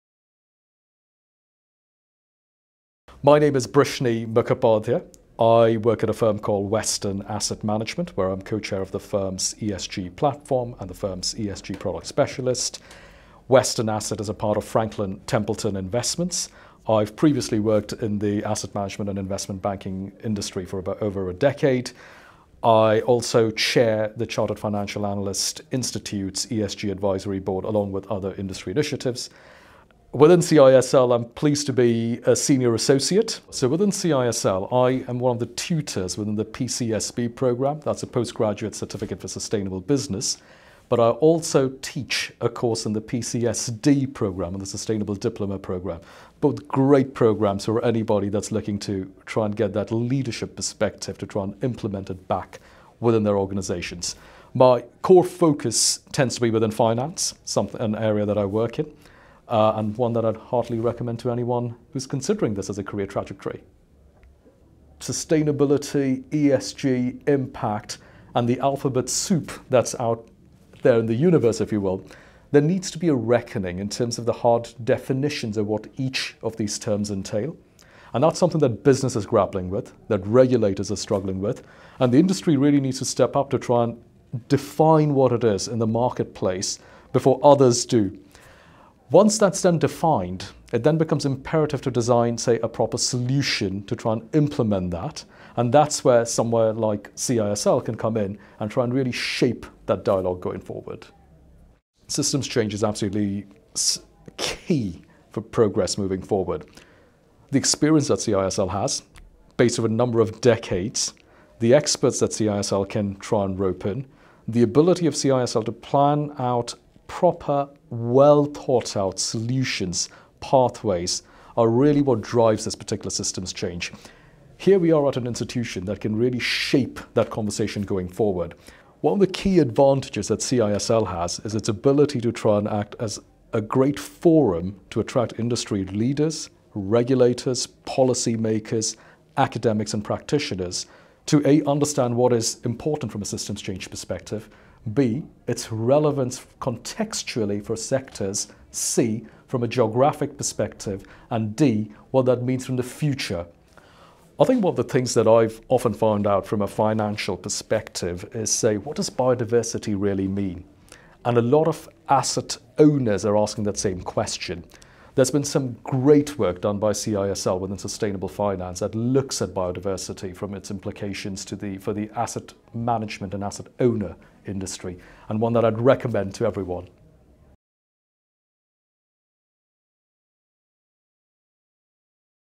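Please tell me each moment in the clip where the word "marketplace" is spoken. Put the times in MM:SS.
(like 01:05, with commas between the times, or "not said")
01:25.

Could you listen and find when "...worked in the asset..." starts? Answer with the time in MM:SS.
00:17.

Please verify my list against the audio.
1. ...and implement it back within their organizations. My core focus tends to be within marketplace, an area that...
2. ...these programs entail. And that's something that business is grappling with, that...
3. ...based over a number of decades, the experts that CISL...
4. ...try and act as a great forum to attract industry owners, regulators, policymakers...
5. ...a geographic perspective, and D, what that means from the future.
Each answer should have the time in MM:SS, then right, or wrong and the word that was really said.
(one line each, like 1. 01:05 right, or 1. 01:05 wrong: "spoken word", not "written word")
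1. 00:51 wrong: "finance", not "marketplace"
2. 01:16 wrong: "terms", not "programs"
3. 01:49 right
4. 02:12 wrong: "leaders", not "owners"
5. 02:29 right.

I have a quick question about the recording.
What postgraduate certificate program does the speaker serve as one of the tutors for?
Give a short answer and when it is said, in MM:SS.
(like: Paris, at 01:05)
PCSB, at 00:36.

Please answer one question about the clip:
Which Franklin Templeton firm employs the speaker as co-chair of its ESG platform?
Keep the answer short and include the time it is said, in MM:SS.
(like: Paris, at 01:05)
Western Asset Management, at 00:06.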